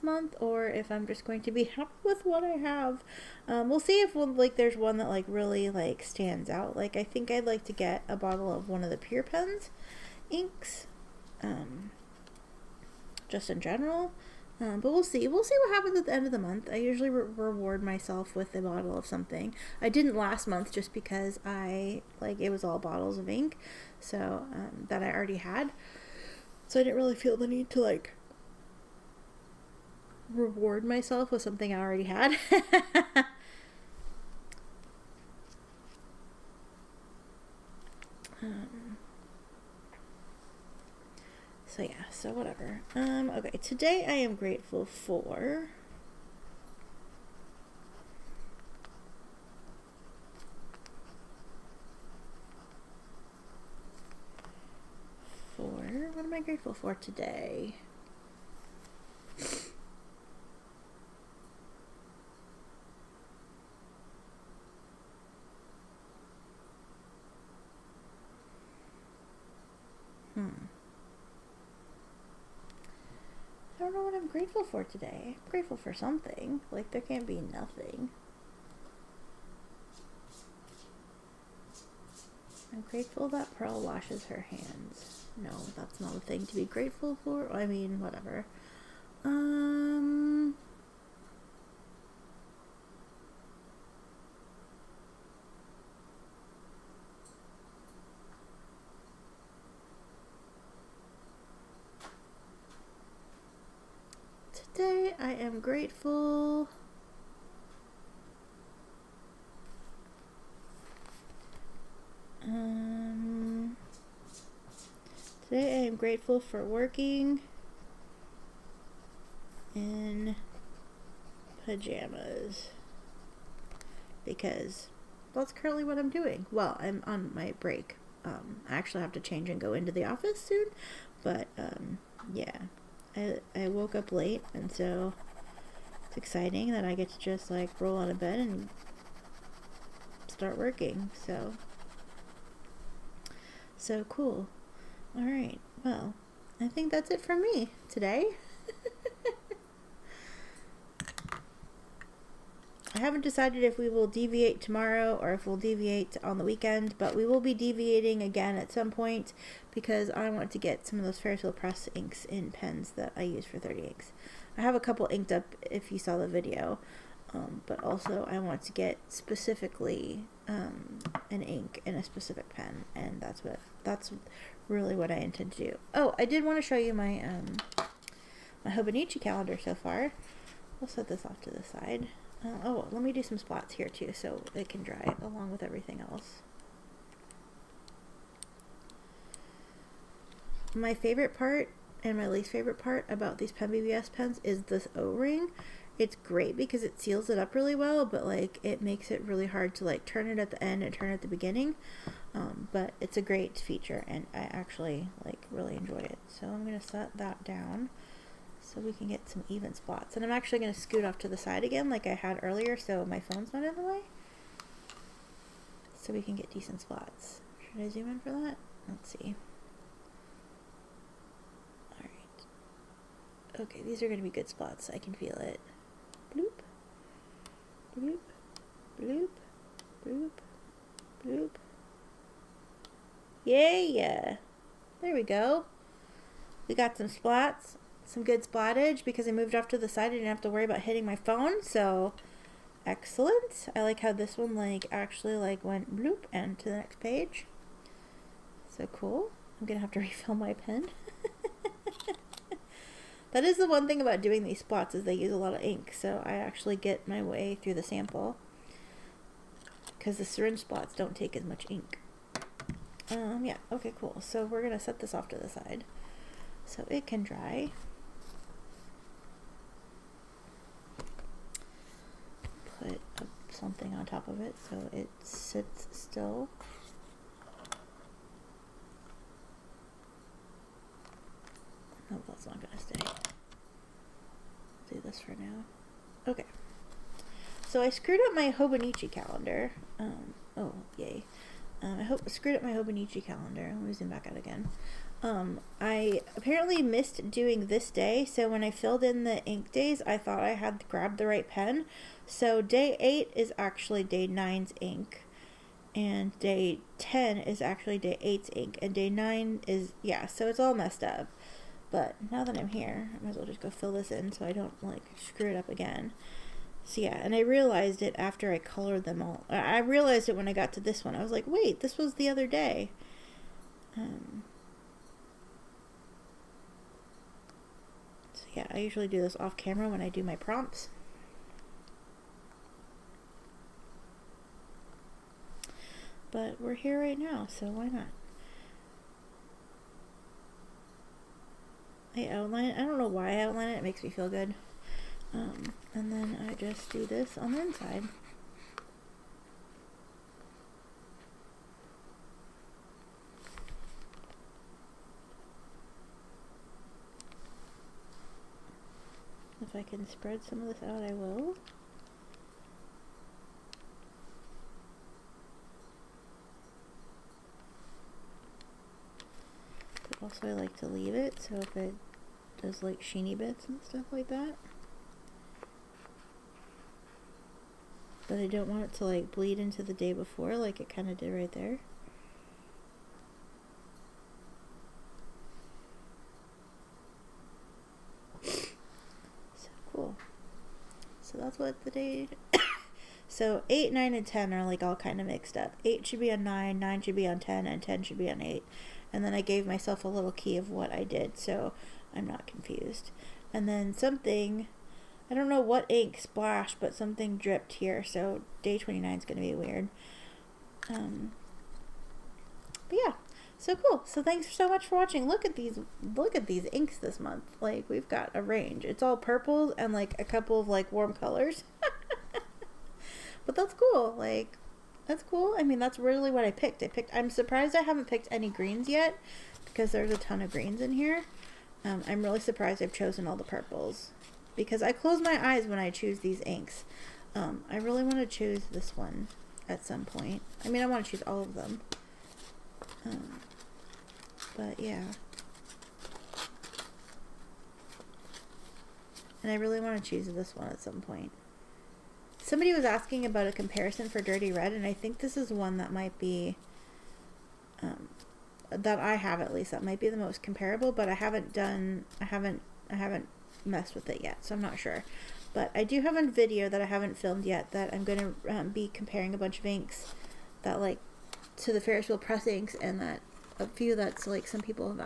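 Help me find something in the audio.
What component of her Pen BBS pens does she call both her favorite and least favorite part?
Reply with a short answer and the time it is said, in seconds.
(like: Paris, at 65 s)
O-ring, at 194 s.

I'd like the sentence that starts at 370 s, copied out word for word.
Also, I like to leave it, so if it does like sheeny bits and stuff like that.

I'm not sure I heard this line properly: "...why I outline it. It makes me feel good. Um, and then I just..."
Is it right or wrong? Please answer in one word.
right.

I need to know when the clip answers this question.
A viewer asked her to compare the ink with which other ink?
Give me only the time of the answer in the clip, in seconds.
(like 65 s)
454 s.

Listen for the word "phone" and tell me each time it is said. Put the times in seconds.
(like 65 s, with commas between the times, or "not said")
213 s, 241 s.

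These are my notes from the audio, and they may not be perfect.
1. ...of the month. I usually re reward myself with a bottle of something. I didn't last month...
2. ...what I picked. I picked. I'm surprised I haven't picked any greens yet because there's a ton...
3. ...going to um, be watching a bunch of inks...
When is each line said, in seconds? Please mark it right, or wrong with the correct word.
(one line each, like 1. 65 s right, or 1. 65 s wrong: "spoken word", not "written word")
1. 16 s right
2. 426 s right
3. 468 s wrong: "comparing", not "watching".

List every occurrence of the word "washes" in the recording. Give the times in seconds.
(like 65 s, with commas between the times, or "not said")
83 s.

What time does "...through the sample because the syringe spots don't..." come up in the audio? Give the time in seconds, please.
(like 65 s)
257 s.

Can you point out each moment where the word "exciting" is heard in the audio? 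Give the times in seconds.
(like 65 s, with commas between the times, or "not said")
136 s.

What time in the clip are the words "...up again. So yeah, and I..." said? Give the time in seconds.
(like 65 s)
315 s.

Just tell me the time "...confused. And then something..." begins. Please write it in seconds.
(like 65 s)
402 s.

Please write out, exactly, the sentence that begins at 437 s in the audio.
Um, I really want to choose this one at some point.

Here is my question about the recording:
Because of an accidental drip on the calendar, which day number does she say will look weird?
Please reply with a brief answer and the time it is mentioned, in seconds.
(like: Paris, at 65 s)
29, at 408 s.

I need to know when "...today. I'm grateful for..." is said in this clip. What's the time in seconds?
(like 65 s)
74 s.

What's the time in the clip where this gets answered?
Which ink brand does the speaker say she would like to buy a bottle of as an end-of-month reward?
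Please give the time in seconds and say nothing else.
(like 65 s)
8 s.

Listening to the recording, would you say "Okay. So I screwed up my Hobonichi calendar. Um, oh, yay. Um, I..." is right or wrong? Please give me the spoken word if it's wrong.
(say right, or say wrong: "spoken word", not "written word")
right.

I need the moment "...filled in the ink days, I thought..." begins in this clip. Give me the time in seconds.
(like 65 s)
298 s.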